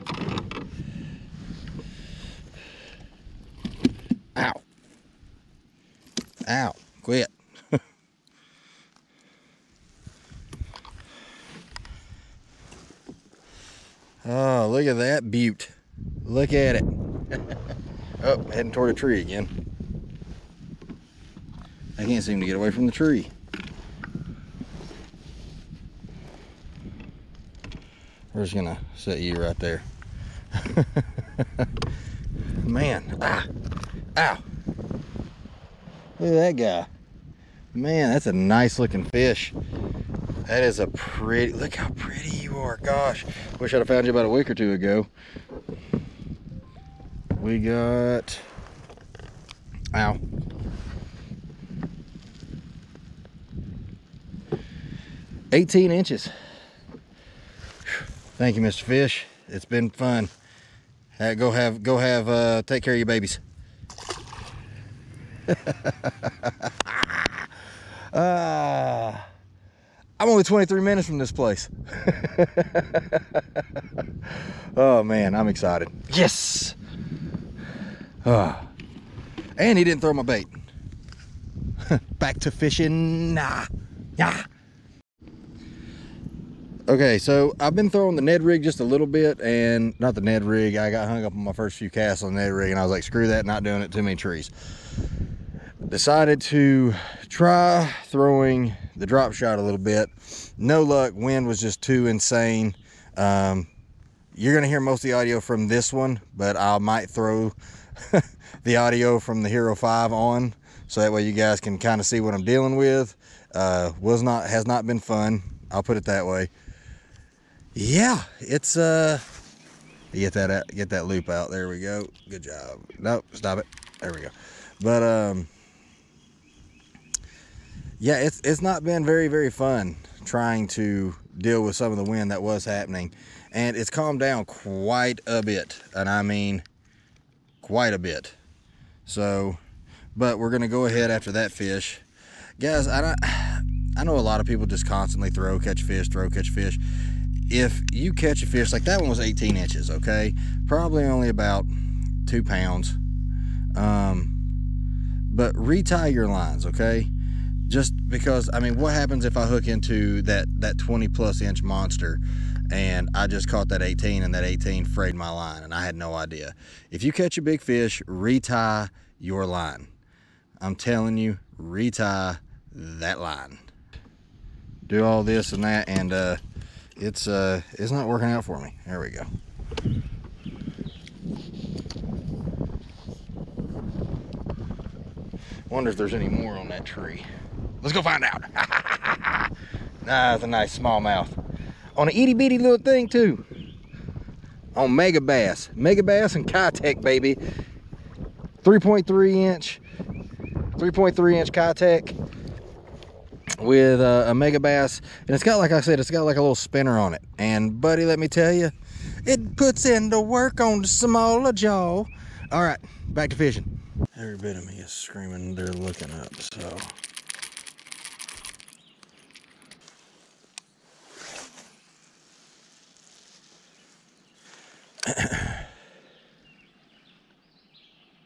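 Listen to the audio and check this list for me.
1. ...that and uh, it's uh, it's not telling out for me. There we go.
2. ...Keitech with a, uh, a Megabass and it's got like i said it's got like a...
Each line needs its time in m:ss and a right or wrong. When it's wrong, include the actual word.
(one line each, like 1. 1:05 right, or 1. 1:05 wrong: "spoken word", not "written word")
1. 2:55 wrong: "working", not "telling"
2. 3:21 right.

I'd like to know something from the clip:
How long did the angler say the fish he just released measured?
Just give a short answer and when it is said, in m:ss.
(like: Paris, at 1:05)
18 inches, at 0:55.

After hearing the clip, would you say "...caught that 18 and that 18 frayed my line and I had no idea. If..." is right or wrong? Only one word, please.
right.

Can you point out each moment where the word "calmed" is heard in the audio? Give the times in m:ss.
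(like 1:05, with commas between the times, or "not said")
2:13.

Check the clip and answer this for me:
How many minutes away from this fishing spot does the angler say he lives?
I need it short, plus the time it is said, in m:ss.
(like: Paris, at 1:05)
23 minutes, at 1:10.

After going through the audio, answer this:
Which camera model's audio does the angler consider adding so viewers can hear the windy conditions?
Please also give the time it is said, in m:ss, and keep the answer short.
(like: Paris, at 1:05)
Hero 5, at 1:49.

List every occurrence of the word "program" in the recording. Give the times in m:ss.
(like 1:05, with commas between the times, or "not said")
not said.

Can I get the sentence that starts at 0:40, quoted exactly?
That is a pretty, look how pretty you are.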